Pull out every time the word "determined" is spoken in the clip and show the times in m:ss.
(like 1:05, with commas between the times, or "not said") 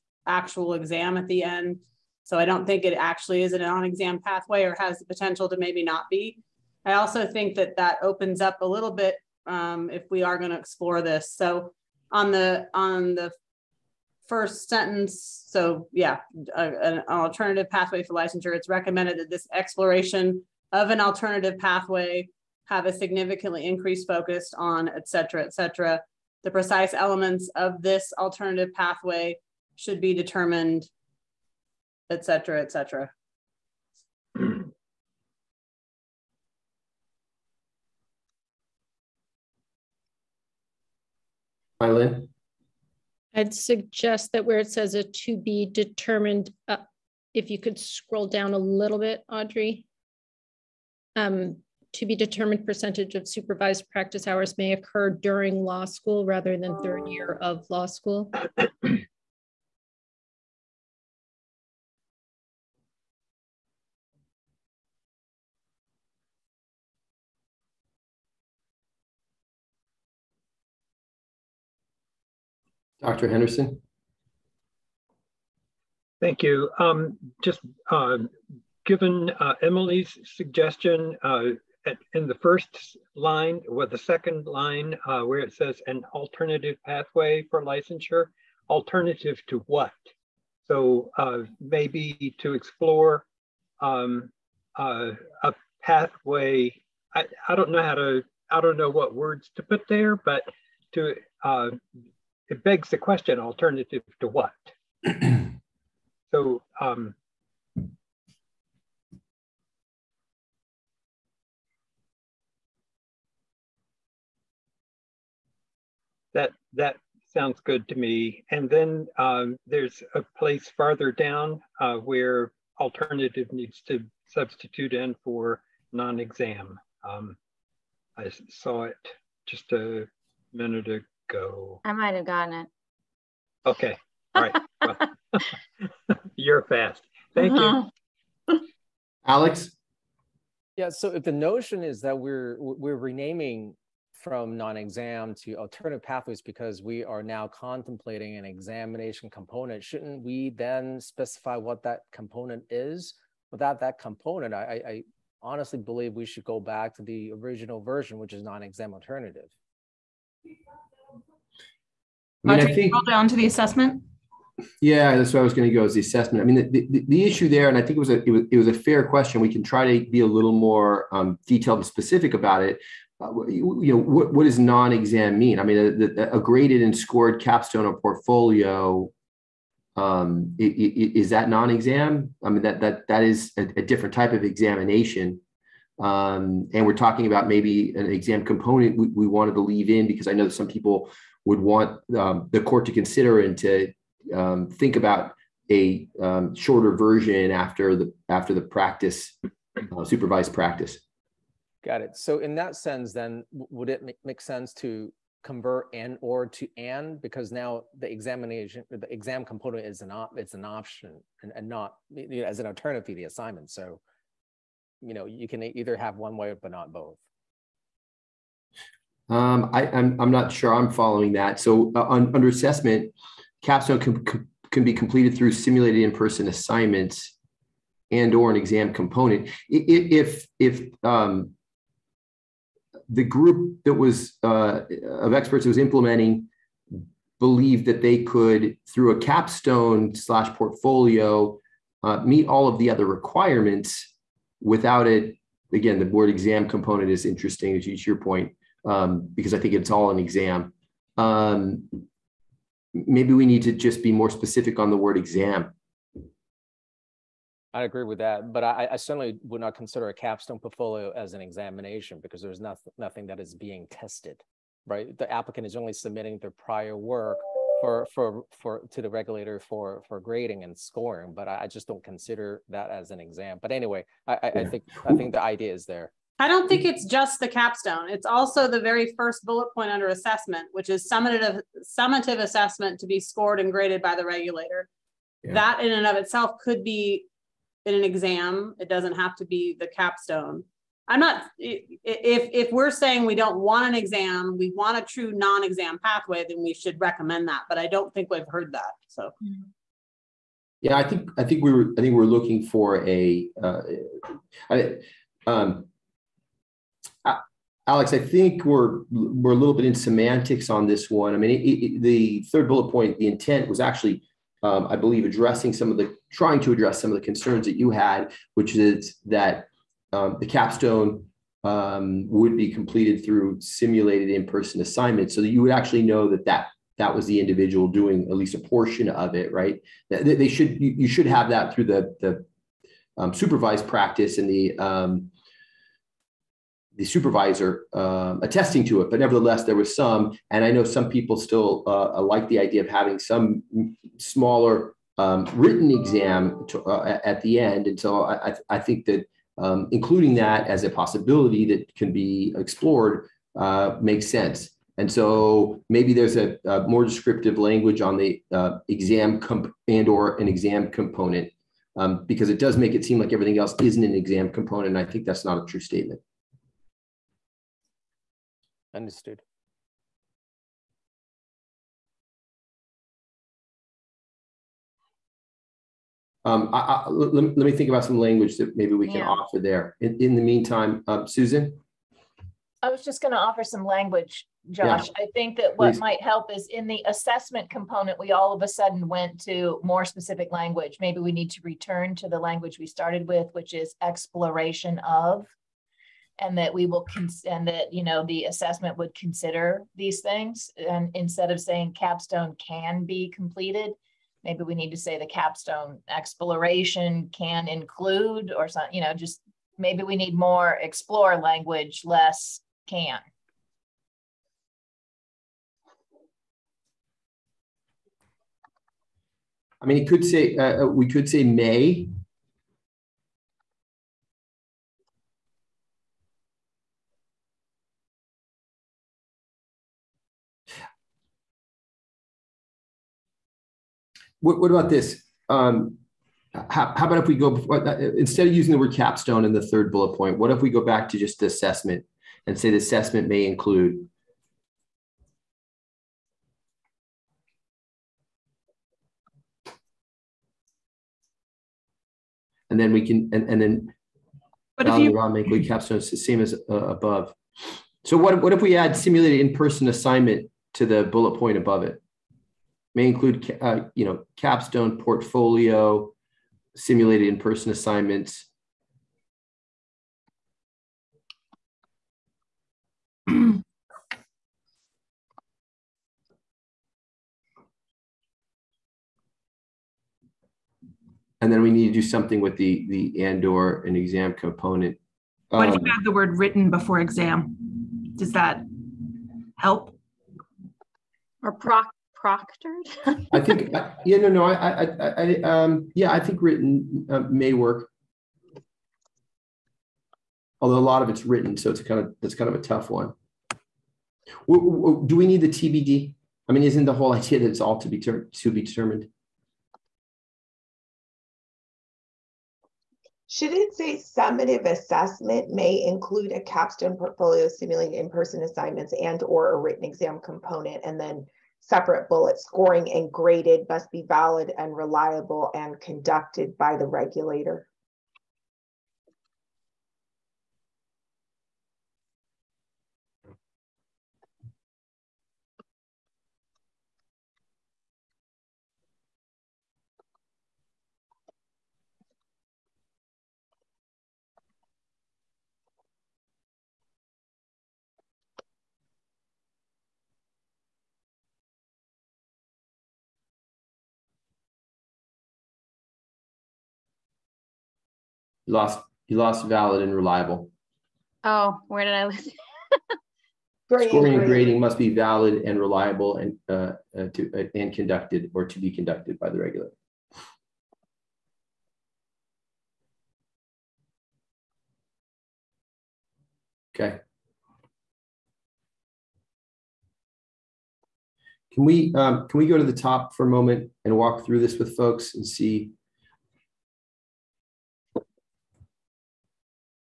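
0:30, 0:45, 0:52, 8:28.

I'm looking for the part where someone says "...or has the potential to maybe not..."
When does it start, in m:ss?
0:04.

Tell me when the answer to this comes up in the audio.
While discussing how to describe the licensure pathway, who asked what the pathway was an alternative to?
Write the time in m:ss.
1:13.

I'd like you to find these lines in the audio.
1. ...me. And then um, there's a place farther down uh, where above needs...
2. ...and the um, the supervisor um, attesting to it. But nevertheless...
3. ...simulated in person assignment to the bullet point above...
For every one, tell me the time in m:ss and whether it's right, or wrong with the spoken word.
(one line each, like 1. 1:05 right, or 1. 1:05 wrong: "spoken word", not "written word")
1. 1:57 wrong: "alternative", not "above"
2. 5:34 right
3. 7:38 right.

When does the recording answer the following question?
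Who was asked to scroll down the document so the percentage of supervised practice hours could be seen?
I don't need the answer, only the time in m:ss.
0:49.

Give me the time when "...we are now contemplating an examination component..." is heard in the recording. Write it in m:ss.
2:26.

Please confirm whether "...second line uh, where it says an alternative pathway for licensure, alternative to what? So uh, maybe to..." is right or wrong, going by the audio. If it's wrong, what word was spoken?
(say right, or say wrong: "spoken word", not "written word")
right.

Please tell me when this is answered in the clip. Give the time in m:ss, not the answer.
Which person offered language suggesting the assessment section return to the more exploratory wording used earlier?
6:21.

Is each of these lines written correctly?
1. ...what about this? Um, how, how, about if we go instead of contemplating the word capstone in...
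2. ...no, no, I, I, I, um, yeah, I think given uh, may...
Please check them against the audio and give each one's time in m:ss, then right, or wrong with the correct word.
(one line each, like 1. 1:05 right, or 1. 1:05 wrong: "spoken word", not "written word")
1. 7:14 wrong: "using", not "contemplating"
2. 8:14 wrong: "written", not "given".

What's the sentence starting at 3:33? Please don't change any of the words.
So you know you can either have one way but not both.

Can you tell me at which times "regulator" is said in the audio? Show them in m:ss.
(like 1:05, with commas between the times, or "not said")
4:29, 4:44, 8:46, 9:29.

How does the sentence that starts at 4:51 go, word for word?
I'm not if if we're saying we don't want an exam, we want a true non-exam pathway, then we should recommend that.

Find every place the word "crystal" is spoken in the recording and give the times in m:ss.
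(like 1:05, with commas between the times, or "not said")
not said.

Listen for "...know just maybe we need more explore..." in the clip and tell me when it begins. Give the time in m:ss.
6:49.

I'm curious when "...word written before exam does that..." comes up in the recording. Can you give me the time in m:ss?
8:06.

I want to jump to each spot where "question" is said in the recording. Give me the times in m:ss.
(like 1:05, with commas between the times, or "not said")
1:42, 2:49.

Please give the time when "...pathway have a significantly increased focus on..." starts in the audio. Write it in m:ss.
0:21.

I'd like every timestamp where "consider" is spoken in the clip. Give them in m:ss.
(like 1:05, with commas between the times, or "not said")
3:12, 4:19, 4:32, 6:39.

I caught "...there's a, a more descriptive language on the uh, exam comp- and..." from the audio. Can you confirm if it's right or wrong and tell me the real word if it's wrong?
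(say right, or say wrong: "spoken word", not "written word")
right.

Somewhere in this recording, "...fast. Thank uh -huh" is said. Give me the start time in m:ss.
2:16.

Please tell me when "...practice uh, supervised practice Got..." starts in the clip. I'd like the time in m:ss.
3:18.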